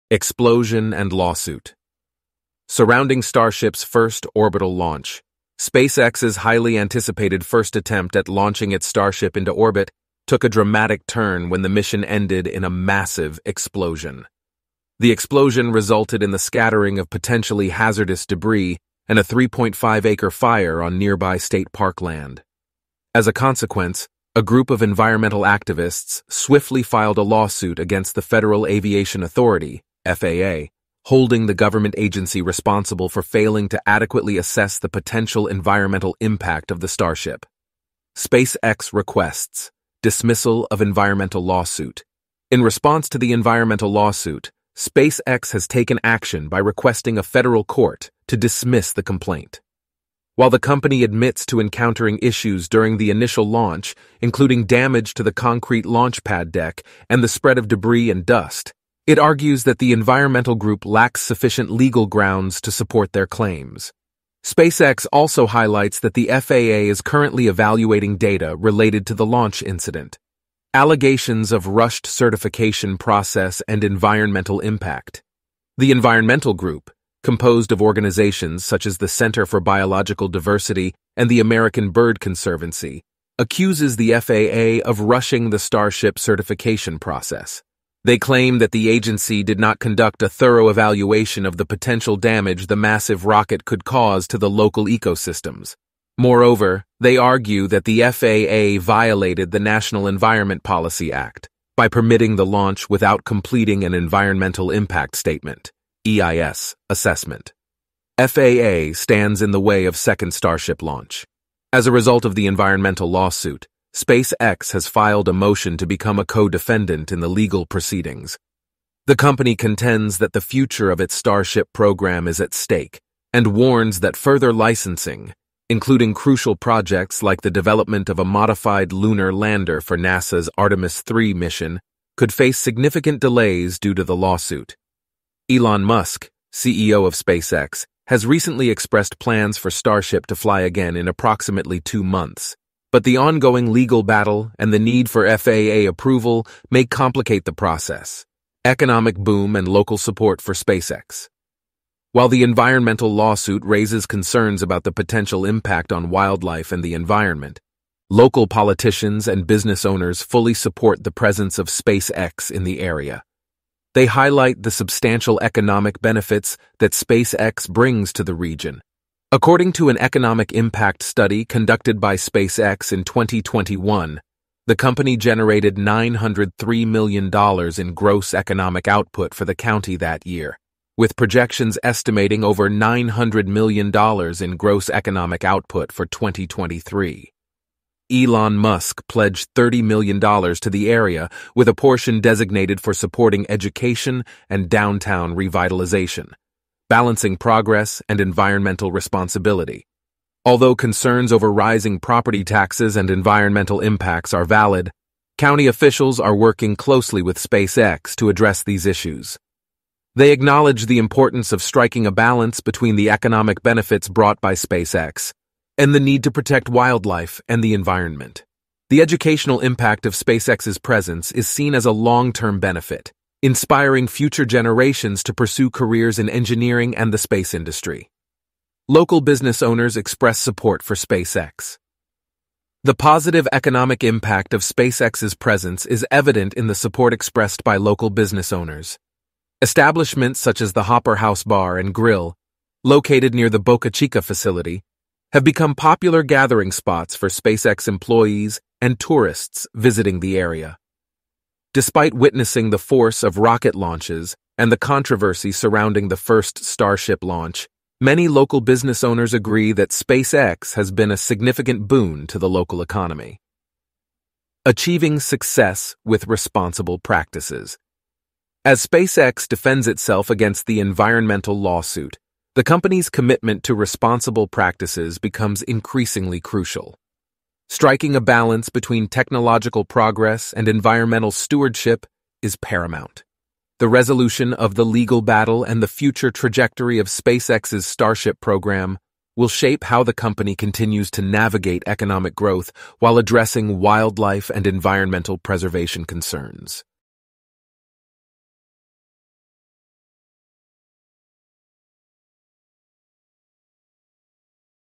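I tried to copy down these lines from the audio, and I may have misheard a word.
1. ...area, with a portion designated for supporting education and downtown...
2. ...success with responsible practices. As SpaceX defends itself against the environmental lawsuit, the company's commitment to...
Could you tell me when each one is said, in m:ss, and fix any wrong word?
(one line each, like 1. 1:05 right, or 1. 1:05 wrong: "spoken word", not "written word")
1. 3:10 right
2. 4:25 right.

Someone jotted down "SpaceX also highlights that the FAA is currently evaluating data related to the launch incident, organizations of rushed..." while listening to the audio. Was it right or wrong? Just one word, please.
wrong.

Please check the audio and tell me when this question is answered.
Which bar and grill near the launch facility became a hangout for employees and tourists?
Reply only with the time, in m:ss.
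4:00.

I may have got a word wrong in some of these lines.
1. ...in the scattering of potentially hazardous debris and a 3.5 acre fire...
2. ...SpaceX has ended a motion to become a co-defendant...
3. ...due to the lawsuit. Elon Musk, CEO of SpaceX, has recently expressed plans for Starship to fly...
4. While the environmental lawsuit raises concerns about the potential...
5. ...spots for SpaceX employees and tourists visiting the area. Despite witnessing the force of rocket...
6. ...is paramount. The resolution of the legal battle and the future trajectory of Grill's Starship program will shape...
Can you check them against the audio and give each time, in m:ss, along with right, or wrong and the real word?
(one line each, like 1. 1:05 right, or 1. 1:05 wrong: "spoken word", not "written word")
1. 0:16 right
2. 1:53 wrong: "filed", not "ended"
3. 2:13 right
4. 2:32 right
5. 4:06 right
6. 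4:42 wrong: "SpaceX", not "Grill".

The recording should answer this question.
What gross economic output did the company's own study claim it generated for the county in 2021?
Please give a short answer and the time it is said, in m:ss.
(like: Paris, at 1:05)
$903 million, at 2:55.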